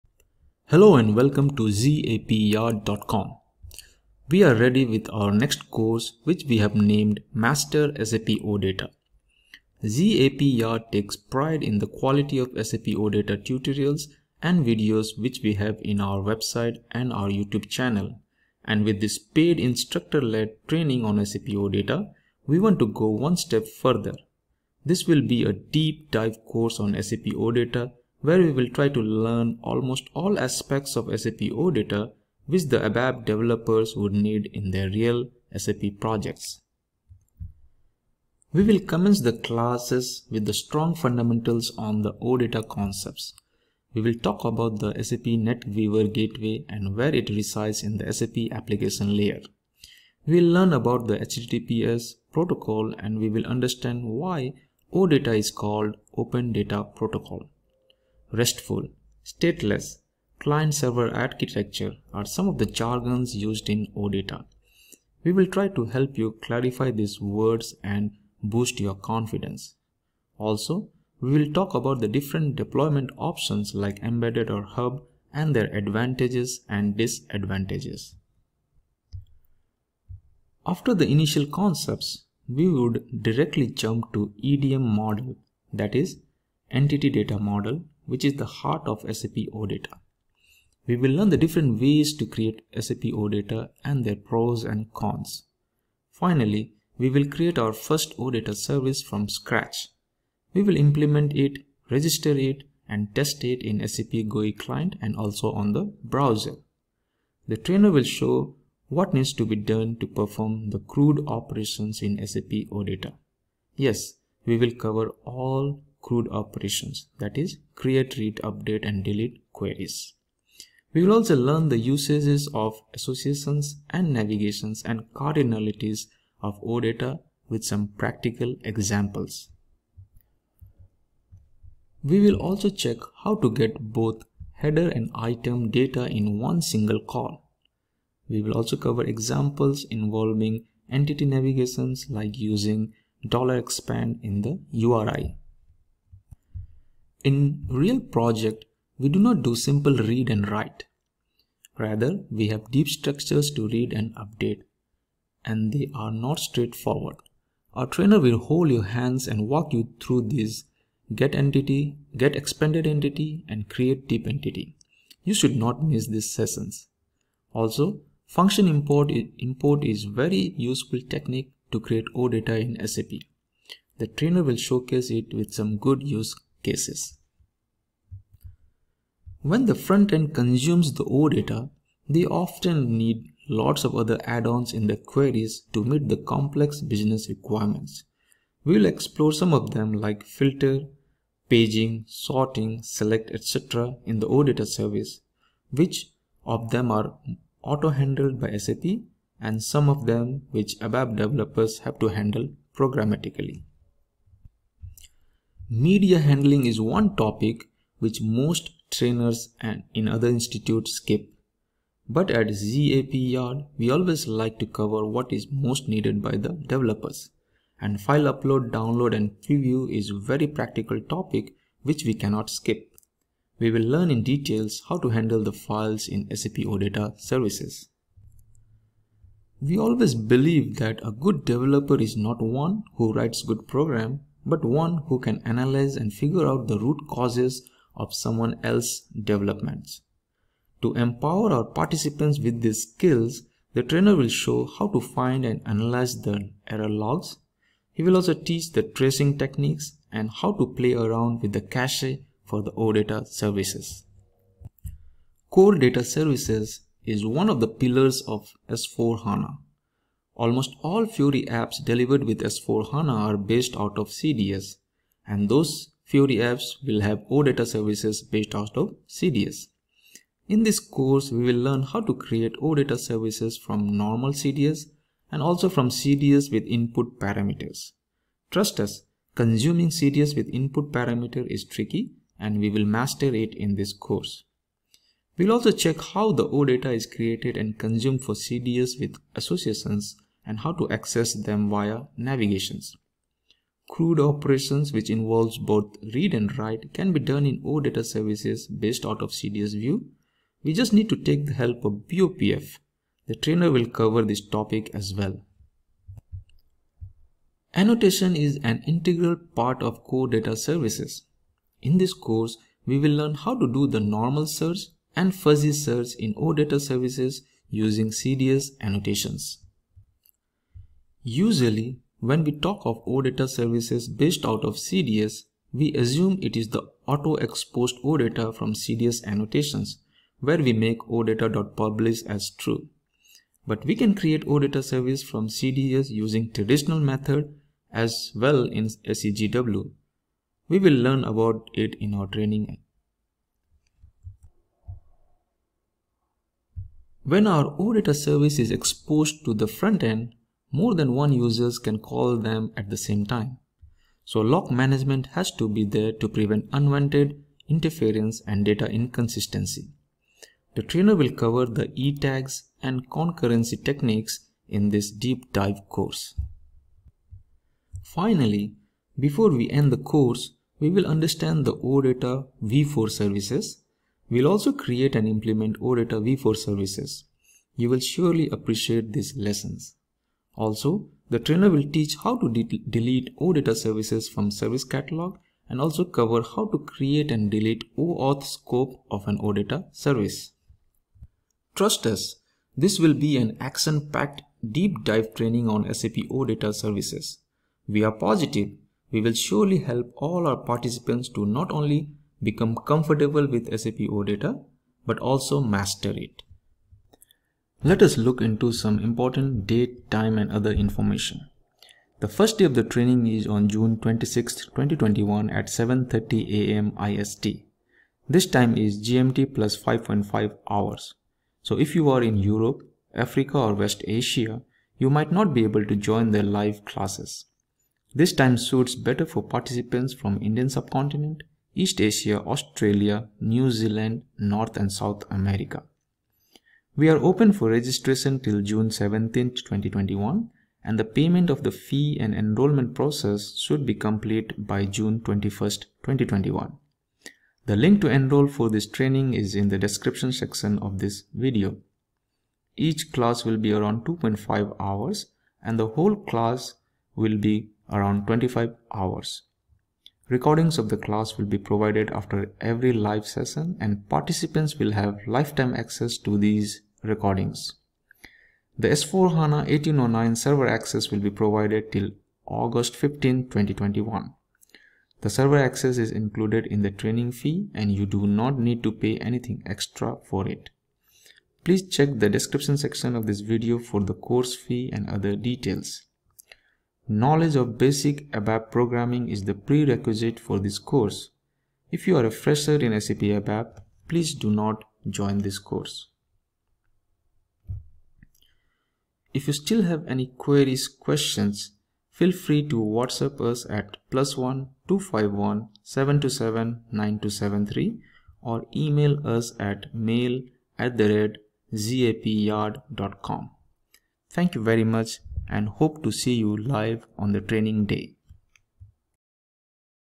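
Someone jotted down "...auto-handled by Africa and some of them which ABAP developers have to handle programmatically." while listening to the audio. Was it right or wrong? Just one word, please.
wrong.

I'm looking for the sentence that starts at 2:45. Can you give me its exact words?
You should not miss these sessions.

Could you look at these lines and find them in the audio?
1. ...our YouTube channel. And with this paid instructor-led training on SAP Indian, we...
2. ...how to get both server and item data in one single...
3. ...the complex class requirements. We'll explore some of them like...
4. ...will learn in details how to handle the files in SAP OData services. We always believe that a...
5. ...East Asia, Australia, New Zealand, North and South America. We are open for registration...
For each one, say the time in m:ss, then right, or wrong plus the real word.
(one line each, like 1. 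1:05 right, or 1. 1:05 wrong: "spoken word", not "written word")
1. 0:17 wrong: "OData", not "Indian"
2. 2:13 wrong: "header", not "server"
3. 3:06 wrong: "business", not "class"
4. 3:43 right
5. 7:11 right.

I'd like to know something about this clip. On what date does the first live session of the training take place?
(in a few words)
June 26, 2021.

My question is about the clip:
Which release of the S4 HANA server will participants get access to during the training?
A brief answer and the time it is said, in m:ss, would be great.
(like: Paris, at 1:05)
1809, at 7:49.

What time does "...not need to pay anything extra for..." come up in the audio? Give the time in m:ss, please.
7:58.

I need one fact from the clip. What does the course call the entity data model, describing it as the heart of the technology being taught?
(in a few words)
EDM model.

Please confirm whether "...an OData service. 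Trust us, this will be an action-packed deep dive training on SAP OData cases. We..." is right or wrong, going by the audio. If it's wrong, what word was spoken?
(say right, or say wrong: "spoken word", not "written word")
wrong: "services", not "cases".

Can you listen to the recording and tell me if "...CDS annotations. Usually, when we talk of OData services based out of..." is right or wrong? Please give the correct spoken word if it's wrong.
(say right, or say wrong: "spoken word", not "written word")
right.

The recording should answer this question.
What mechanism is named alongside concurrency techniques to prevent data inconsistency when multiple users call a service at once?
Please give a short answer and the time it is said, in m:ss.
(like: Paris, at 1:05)
e-tags, at 6:01.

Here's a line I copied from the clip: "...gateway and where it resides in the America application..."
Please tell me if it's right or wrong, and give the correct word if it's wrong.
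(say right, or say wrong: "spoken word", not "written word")
wrong: "SAP", not "America".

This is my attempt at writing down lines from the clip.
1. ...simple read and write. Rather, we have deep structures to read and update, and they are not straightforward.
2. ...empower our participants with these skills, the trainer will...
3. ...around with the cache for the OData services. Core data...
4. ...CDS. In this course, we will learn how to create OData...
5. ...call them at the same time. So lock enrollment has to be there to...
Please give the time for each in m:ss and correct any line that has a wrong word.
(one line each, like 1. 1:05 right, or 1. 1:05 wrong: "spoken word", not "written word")
1. 2:29 right
2. 4:00 right
3. 4:10 right
4. 4:29 right
5. 5:51 wrong: "management", not "enrollment".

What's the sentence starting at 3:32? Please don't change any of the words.
But at ZAP Yard, we always like to cover what is most needed by the developers.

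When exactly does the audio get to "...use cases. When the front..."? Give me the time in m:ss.
2:56.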